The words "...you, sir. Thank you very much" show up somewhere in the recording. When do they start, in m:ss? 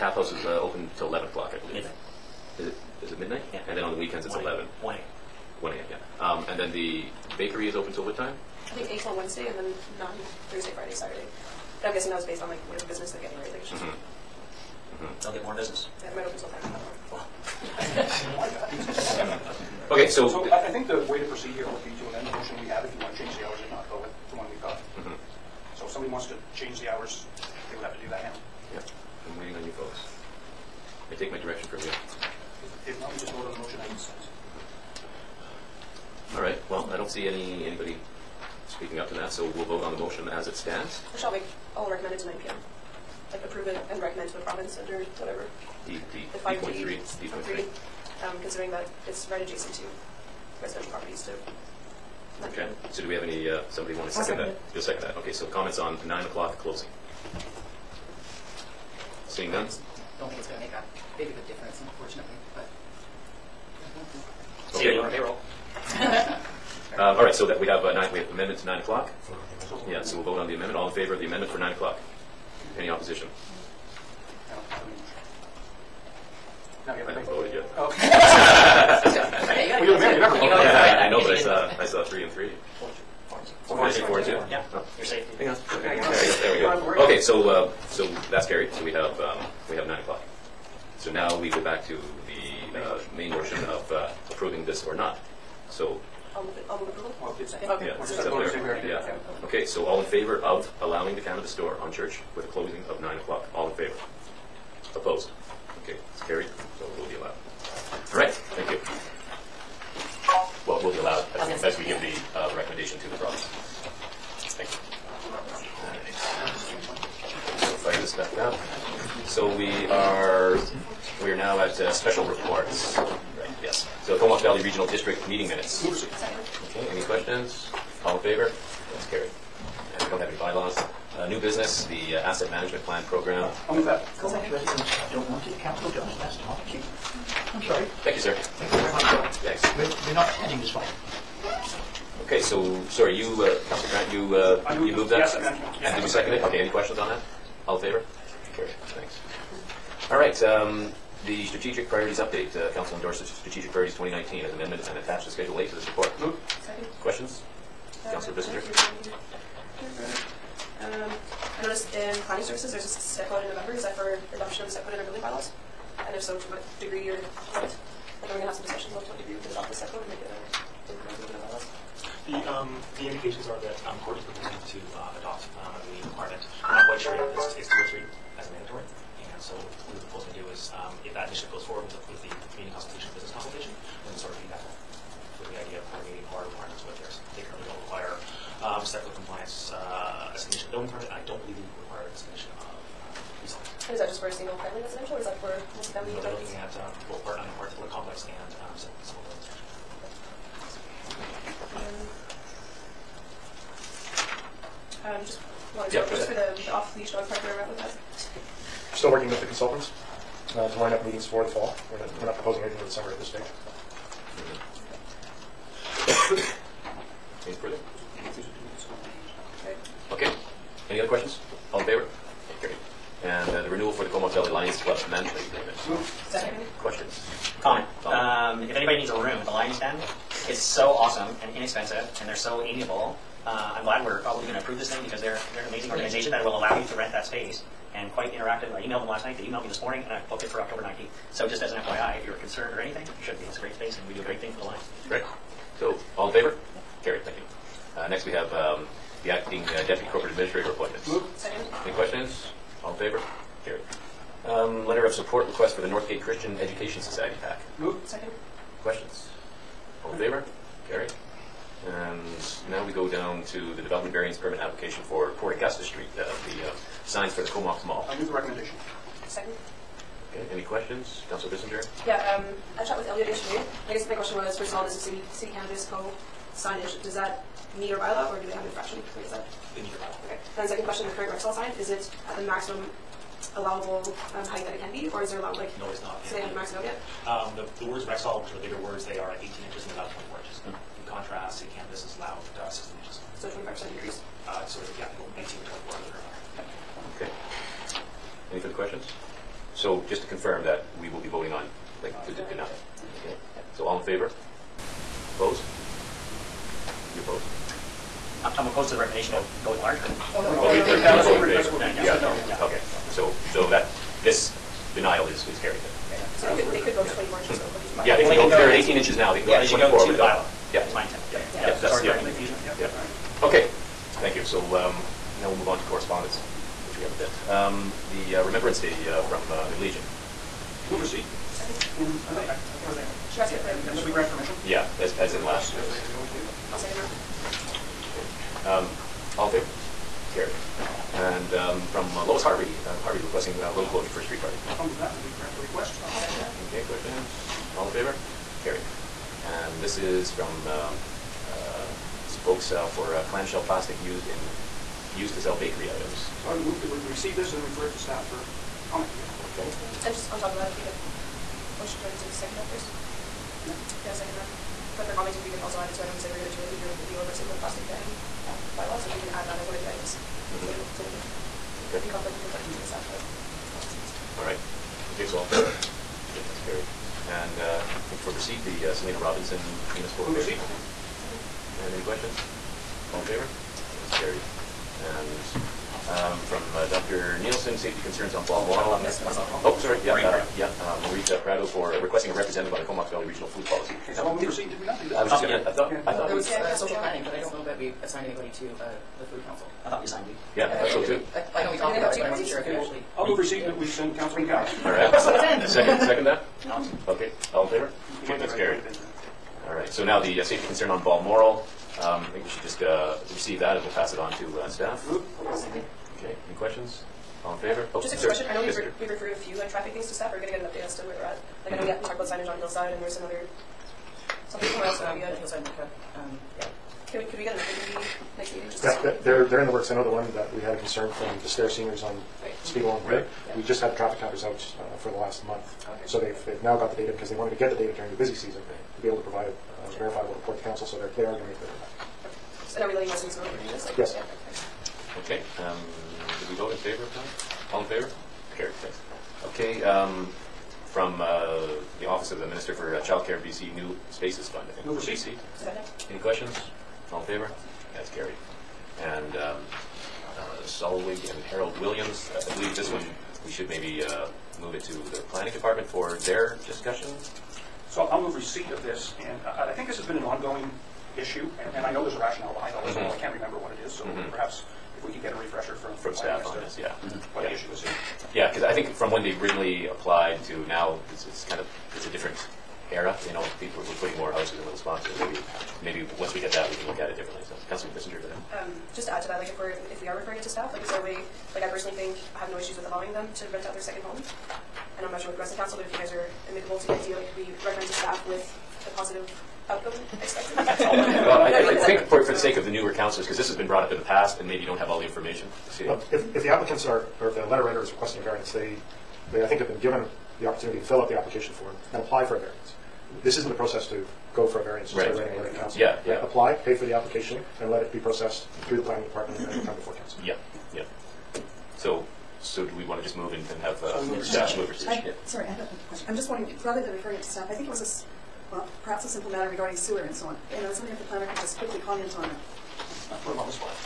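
2:18.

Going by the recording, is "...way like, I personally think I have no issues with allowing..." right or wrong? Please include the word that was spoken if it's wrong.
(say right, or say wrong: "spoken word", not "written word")
right.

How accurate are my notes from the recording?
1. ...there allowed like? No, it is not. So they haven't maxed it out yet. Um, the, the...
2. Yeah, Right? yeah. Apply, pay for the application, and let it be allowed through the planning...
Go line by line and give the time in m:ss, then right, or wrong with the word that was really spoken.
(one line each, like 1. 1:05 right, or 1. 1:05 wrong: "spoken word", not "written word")
1. 4:45 right
2. 8:35 wrong: "processed", not "allowed".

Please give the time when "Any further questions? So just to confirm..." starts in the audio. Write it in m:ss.
4:58.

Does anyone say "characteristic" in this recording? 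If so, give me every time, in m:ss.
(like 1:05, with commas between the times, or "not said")
not said.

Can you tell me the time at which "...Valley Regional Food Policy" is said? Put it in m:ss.
6:33.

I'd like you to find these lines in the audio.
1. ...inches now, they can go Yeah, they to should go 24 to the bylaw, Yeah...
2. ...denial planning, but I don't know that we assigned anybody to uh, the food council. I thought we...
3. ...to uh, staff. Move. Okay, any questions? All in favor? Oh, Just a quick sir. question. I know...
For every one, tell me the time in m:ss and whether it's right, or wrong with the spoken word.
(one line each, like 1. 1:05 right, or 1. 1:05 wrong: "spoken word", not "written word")
1. 5:18 right
2. 6:36 wrong: "social", not "denial"
3. 6:54 right.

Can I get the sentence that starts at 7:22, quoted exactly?
And are we letting residents know that we're doing this?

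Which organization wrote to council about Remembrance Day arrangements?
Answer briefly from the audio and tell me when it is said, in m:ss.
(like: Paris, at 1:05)
the Legion, at 5:29.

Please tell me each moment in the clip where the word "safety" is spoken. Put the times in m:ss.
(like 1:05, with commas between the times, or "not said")
1:25, 6:27, 6:50.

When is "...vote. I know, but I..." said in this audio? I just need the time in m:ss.
1:20.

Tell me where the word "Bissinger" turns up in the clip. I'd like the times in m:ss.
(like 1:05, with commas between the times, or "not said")
2:38, 4:31, 8:07.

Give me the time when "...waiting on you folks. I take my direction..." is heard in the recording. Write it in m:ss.
0:29.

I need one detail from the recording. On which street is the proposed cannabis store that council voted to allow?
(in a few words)
Church.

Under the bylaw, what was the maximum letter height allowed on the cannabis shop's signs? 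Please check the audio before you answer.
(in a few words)
16 inches.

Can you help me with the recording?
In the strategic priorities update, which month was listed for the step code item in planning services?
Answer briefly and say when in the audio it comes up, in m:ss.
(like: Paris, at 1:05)
November, at 2:43.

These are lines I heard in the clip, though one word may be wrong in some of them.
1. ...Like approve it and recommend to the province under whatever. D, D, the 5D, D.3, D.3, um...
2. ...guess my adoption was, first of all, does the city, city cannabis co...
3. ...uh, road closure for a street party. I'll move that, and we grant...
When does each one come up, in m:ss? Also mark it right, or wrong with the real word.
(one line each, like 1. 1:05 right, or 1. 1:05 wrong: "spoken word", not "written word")
1. 0:43 right
2. 4:33 wrong: "question", not "adoption"
3. 5:43 right.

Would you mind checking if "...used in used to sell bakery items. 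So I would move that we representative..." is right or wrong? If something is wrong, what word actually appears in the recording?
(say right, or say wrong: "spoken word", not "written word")
wrong: "receive", not "representative".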